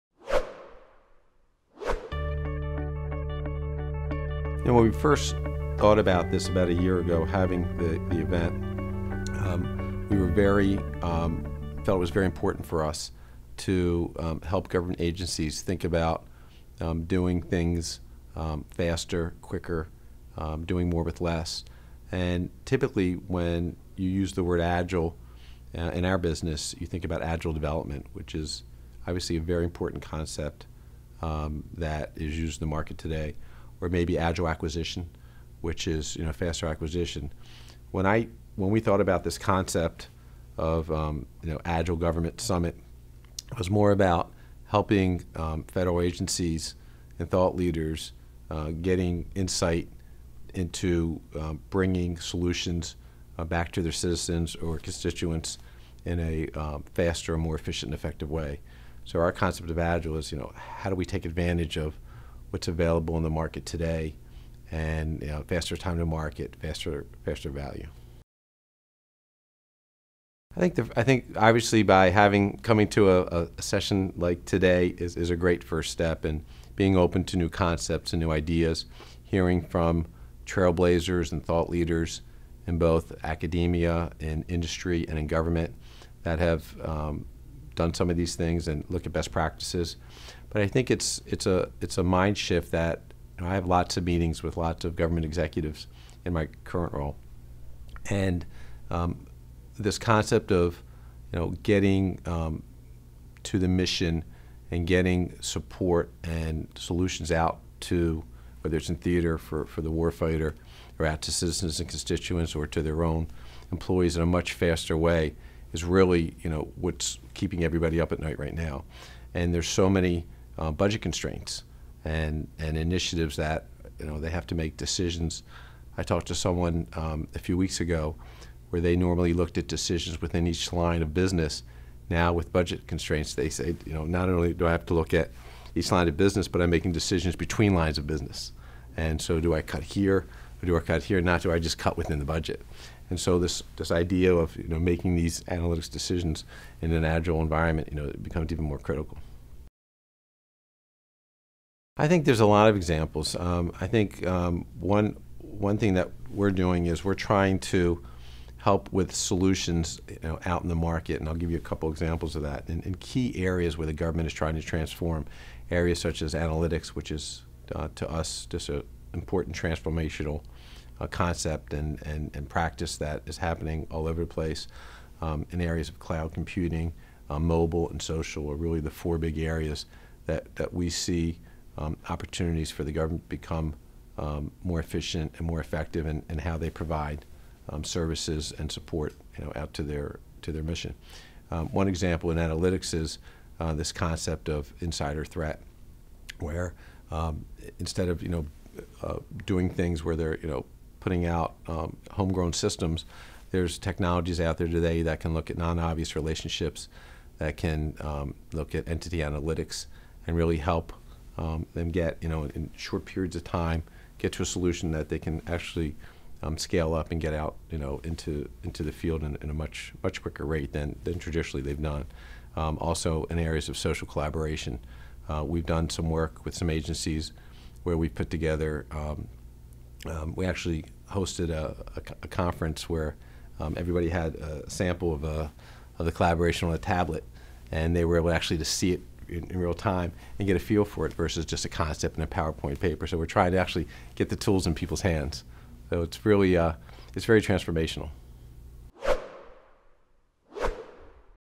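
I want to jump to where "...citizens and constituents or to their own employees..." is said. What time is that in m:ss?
1:51.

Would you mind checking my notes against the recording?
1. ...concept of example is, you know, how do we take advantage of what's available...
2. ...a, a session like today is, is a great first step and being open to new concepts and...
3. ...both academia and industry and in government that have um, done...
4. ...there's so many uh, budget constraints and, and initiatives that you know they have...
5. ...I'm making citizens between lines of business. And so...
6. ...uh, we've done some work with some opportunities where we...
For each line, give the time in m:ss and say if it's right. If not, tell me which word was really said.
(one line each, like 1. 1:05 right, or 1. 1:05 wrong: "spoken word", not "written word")
1. 0:59 wrong: "agile", not "example"
2. 1:13 right
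3. 1:22 right
4. 1:59 right
5. 2:16 wrong: "decisions", not "citizens"
6. 3:45 wrong: "agencies", not "opportunities".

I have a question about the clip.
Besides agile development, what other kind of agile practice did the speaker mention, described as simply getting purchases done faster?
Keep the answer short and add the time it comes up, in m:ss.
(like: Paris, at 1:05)
Agile acquisition, at 0:34.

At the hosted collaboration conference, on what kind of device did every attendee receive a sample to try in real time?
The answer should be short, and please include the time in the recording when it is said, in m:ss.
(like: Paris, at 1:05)
A tablet, at 3:56.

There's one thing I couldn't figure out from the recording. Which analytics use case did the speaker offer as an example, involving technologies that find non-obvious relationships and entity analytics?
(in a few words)
Insider threat.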